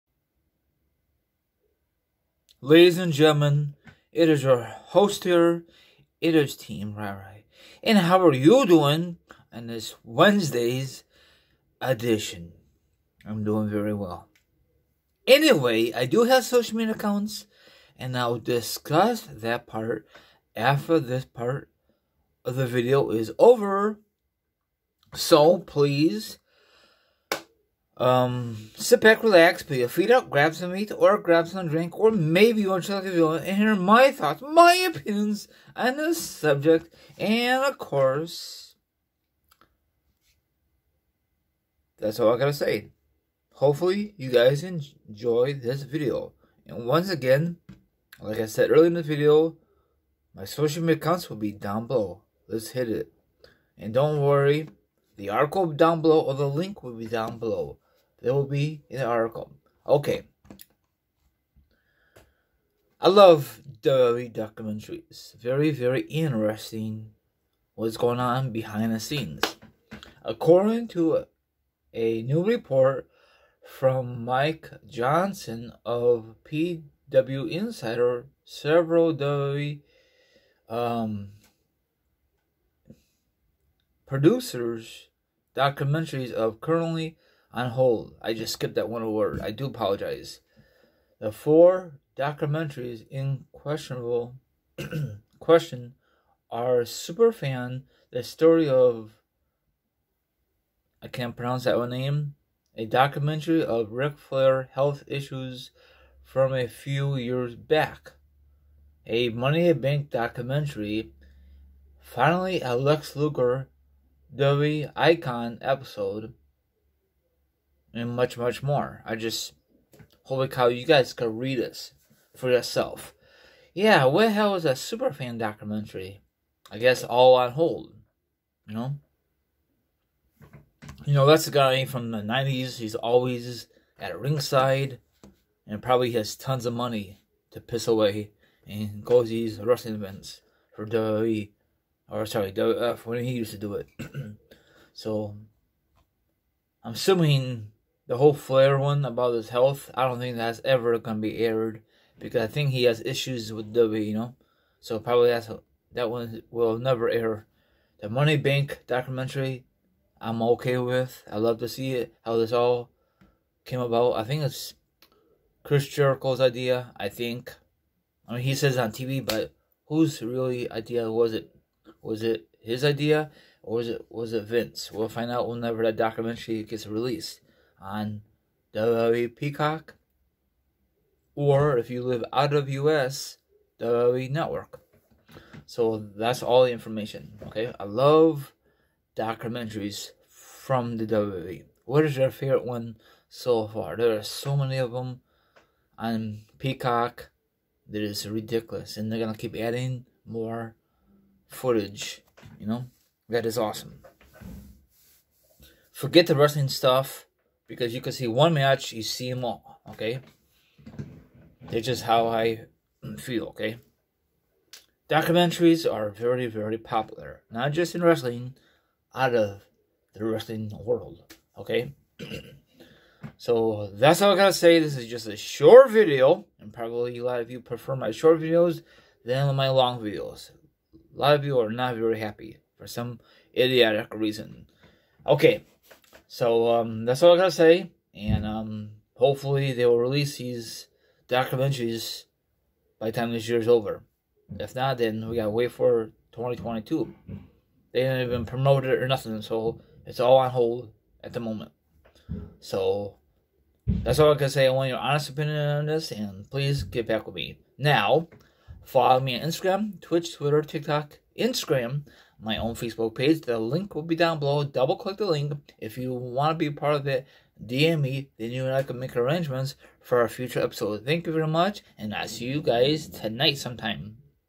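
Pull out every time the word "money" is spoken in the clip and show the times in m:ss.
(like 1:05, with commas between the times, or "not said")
1:49, 2:16, 2:38.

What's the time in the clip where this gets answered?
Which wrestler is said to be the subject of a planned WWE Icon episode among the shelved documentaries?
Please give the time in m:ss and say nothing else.
1:52.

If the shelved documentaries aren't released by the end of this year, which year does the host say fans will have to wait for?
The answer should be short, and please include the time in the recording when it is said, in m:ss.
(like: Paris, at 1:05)
2022, at 4:06.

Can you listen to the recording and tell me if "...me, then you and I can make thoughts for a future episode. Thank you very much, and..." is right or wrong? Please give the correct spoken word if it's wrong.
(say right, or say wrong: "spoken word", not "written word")
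wrong: "arrangements", not "thoughts".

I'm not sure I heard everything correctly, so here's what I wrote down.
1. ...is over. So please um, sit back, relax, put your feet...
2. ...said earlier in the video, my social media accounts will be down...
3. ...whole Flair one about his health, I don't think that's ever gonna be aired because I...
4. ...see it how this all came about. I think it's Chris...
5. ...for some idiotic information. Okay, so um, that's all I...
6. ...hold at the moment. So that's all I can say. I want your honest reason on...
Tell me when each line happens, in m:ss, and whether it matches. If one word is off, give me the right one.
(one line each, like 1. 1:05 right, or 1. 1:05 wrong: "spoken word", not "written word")
1. 0:23 right
2. 0:48 right
3. 2:28 right
4. 2:41 right
5. 3:52 wrong: "reason", not "information"
6. 4:10 wrong: "opinion", not "reason".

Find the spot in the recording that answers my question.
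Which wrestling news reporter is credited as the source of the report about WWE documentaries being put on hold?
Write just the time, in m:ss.
1:14.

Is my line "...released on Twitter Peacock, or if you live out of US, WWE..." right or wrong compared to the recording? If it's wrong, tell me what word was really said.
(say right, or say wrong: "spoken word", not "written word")
wrong: "WWE", not "Twitter".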